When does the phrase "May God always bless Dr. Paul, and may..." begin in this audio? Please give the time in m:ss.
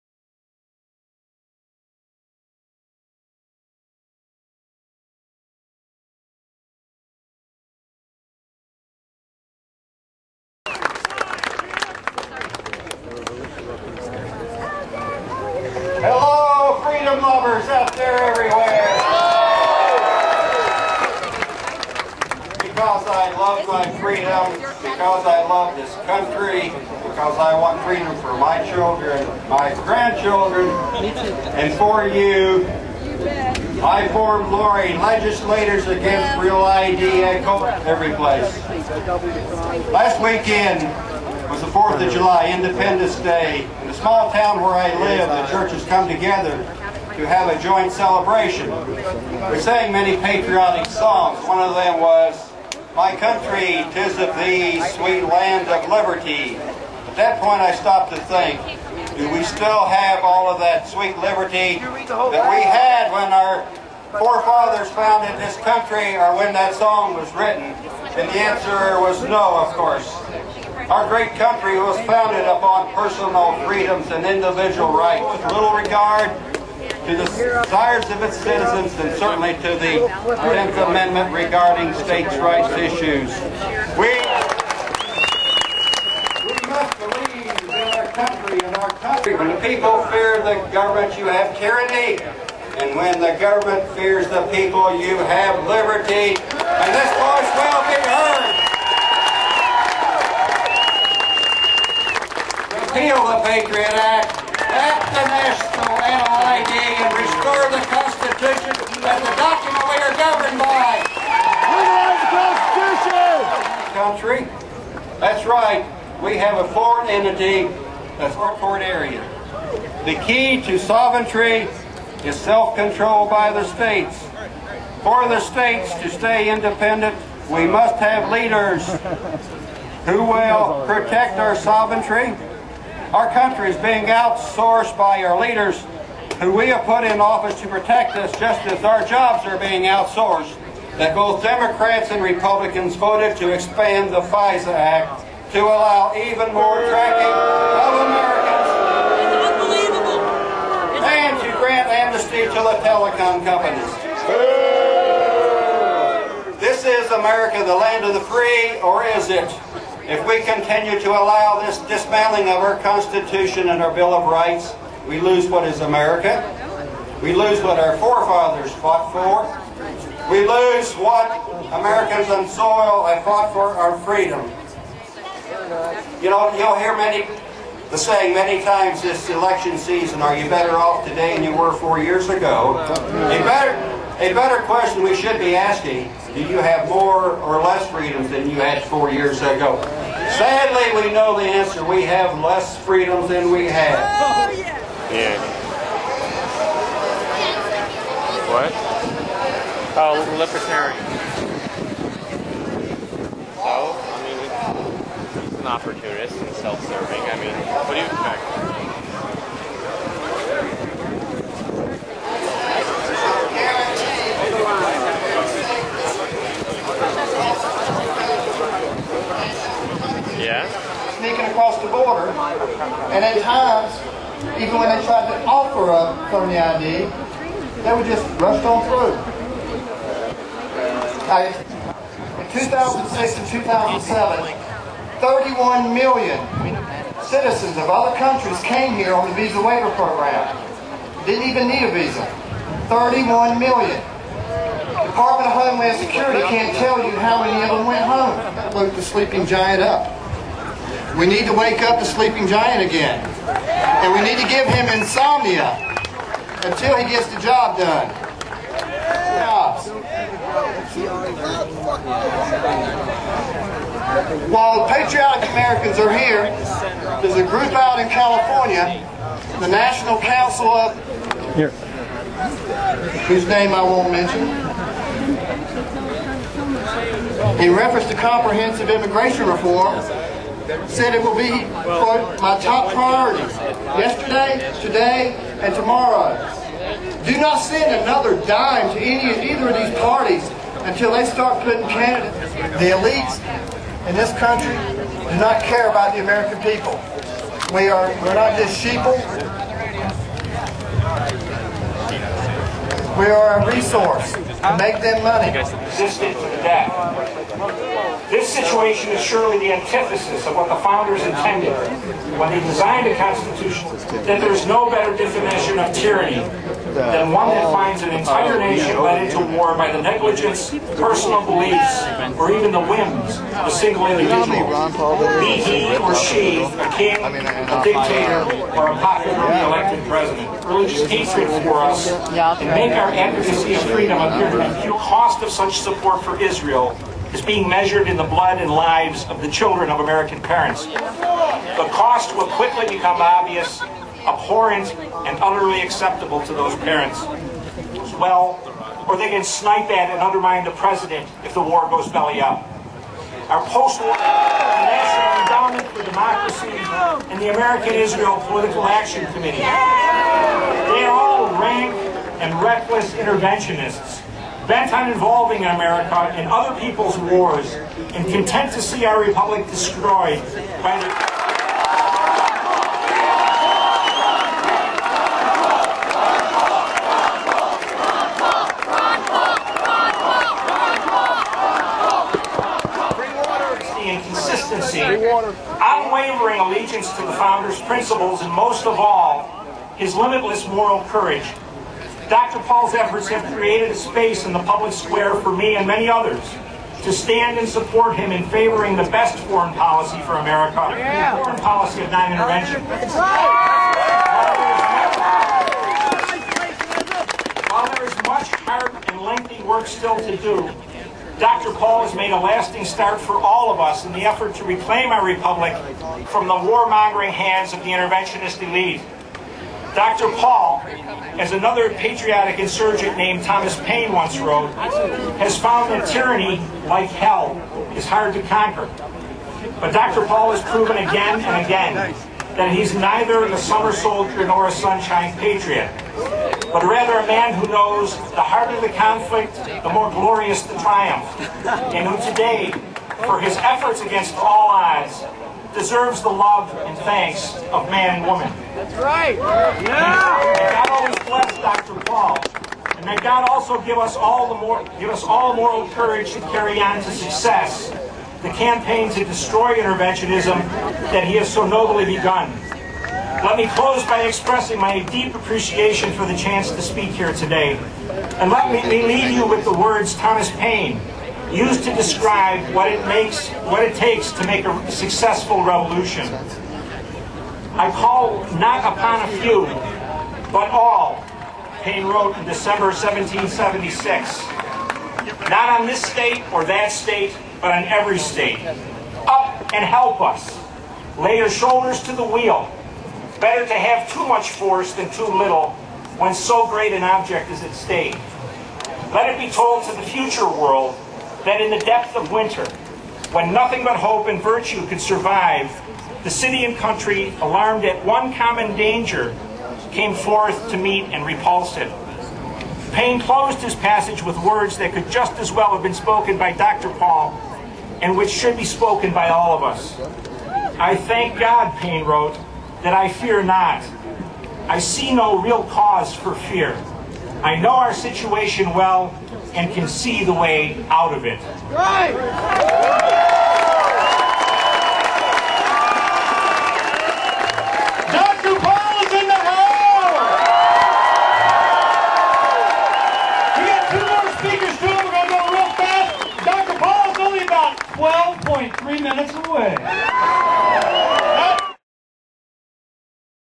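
7:30.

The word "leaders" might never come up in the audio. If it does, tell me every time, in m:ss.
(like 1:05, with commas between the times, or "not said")
2:08, 2:15.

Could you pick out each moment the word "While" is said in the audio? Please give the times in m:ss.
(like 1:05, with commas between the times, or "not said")
4:24, 6:47.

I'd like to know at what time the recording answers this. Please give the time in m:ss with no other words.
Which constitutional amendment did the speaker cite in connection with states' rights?
1:20.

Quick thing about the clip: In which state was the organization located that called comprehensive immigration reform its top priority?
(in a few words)
California.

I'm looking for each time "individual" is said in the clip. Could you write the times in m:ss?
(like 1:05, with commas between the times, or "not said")
1:14, 5:24.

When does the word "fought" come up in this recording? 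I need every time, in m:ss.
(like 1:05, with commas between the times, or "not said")
2:48, 2:53.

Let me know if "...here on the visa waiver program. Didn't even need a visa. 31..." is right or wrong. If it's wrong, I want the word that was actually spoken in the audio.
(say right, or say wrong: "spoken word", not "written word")
right.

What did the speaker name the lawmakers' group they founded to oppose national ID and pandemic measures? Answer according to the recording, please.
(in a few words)
Lori.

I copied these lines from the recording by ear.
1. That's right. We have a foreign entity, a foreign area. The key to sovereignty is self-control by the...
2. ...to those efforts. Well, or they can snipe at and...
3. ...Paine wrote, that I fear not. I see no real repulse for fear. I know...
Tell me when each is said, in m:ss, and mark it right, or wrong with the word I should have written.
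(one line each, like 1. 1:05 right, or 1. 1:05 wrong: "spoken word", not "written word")
1. 1:55 right
2. 5:46 wrong: "parents", not "efforts"
3. 8:41 wrong: "cause", not "repulse".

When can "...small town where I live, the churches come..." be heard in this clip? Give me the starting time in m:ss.
0:43.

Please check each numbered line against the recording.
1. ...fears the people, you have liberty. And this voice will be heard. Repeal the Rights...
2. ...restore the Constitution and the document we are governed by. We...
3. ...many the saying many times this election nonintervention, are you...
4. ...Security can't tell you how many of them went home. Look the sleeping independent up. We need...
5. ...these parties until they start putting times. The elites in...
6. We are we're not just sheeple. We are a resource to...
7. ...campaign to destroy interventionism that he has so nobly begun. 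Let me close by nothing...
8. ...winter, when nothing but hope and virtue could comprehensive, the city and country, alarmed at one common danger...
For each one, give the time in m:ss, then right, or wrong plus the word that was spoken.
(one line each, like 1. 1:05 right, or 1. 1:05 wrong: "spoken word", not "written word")
1. 1:33 wrong: "Patriot", not "Rights"
2. 1:47 right
3. 2:56 wrong: "season", not "nonintervention"
4. 4:05 wrong: "giant", not "independent"
5. 4:49 wrong: "candidates", not "times"
6. 4:57 right
7. 7:38 wrong: "expressing", not "nothing"
8. 8:22 wrong: "survive", not "comprehensive".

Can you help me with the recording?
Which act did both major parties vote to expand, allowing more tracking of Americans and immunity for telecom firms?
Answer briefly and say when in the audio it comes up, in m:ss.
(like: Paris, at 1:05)
FISA Act, at 2:24.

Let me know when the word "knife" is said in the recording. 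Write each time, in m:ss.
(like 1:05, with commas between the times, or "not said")
not said.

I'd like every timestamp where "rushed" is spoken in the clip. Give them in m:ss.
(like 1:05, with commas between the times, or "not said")
3:48.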